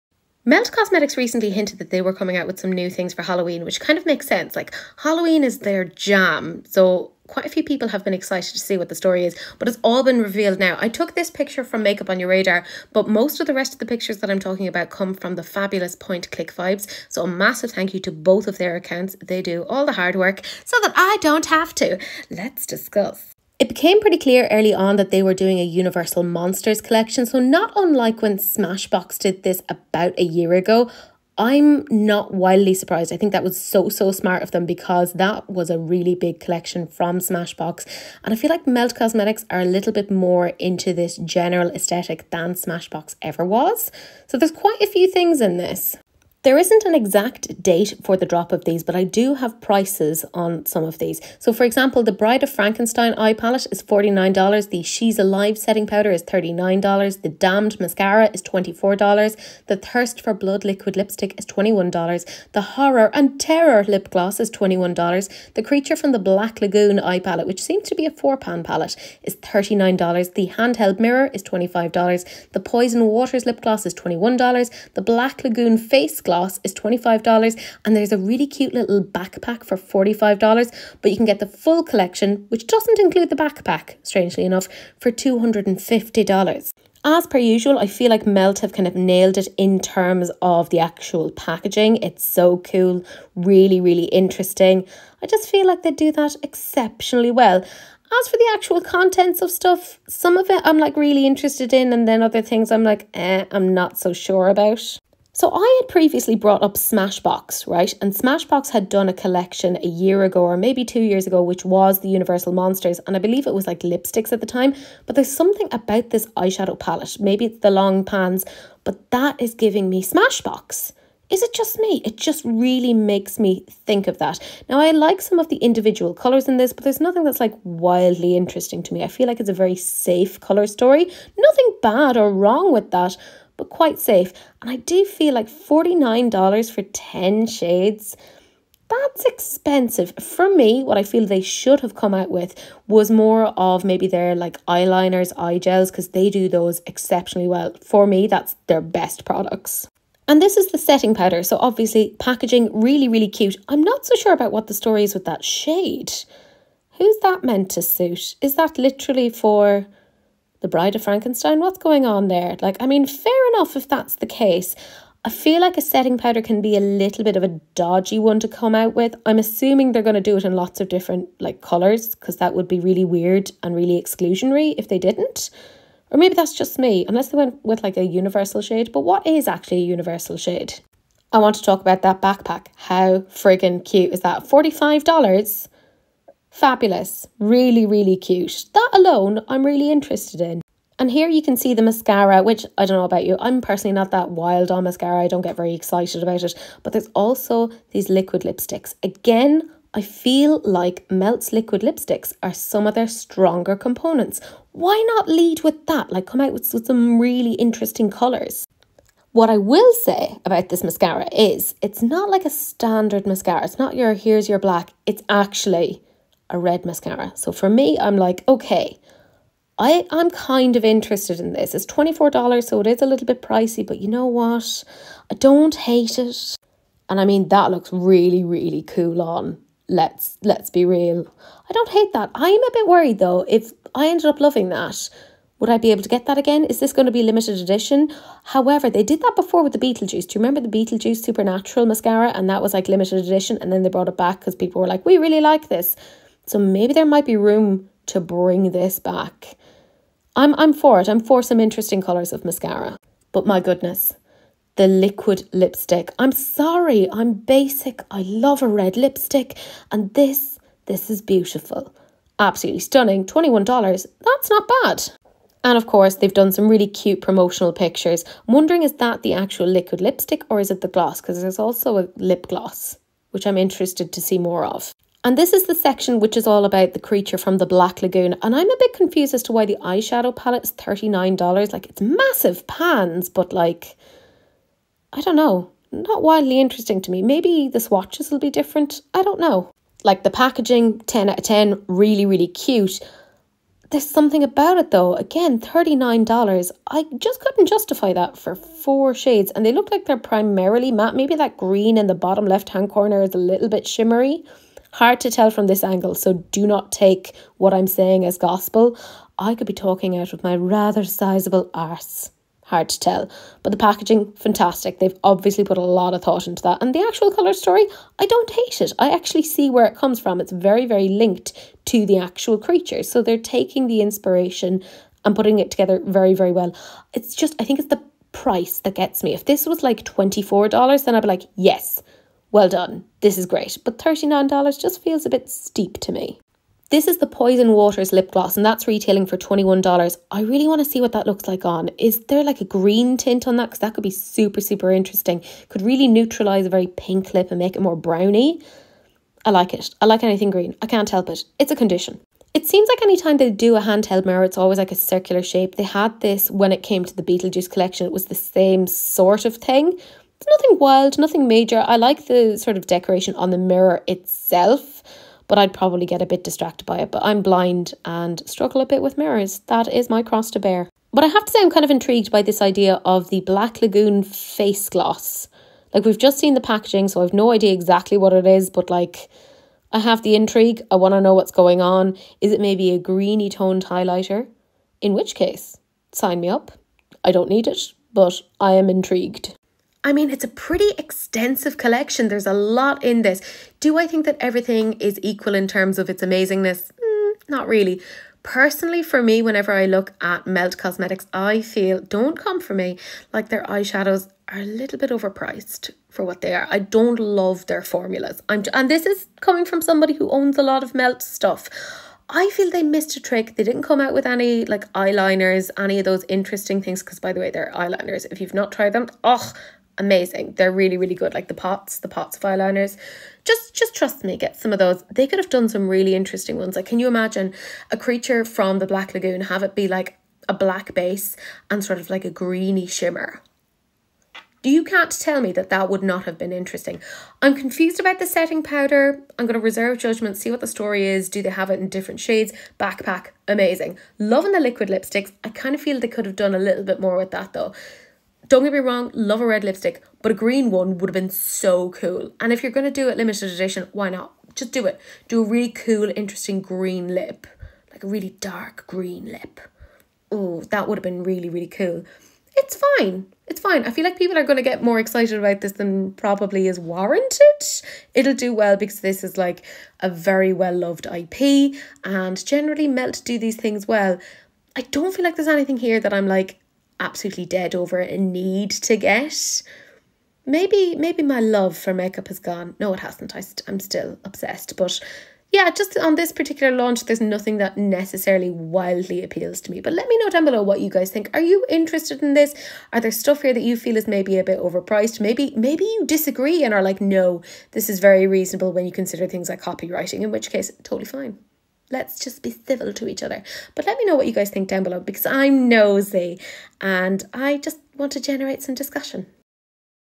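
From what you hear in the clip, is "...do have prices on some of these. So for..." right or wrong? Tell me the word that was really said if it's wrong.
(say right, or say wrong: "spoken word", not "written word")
right.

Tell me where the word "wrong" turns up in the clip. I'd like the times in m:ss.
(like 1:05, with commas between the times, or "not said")
2:12, 7:28.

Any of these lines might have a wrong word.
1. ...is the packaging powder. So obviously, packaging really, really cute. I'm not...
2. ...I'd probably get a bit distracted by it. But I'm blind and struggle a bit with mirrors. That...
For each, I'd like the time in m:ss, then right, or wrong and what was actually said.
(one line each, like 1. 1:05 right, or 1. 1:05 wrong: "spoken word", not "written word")
1. 2:30 wrong: "setting", not "packaging"
2. 6:05 right.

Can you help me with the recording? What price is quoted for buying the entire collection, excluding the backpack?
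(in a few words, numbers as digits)
$250.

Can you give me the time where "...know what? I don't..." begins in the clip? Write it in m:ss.
3:44.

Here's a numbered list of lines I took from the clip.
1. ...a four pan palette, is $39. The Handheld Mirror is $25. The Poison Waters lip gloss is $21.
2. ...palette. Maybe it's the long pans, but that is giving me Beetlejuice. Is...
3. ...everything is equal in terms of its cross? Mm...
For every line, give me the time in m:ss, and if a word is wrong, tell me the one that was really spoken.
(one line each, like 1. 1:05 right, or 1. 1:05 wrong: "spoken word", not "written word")
1. 1:08 right
2. 1:56 wrong: "Smashbox", not "Beetlejuice"
3. 6:34 wrong: "amazingness", not "cross".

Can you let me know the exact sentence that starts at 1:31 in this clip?
It's so cool, really, really interesting.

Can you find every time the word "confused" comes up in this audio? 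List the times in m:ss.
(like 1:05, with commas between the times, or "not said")
4:38, 7:17.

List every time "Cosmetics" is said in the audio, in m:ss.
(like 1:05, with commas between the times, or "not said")
0:00, 0:38, 6:40.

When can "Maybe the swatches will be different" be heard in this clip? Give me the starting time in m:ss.
4:47.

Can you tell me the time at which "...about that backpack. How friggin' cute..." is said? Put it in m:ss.
3:01.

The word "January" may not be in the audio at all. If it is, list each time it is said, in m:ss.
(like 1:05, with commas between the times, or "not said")
not said.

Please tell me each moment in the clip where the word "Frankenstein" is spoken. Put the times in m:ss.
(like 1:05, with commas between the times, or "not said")
0:52, 2:41.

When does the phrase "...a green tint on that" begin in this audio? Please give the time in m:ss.
5:42.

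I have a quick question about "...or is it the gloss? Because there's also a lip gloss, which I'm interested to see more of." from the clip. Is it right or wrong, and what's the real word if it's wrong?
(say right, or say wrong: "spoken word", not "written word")
right.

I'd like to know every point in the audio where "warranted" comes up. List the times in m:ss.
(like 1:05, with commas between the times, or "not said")
7:46.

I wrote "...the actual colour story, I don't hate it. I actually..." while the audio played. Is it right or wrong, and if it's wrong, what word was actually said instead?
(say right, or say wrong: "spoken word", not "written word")
right.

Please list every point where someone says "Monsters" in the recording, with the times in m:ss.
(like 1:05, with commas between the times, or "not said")
0:26, 1:52.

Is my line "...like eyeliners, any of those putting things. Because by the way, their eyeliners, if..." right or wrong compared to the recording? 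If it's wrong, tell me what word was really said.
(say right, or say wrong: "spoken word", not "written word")
wrong: "interesting", not "putting".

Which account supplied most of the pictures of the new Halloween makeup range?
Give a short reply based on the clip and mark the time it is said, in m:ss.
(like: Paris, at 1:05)
Point Click Vibes, at 0:15.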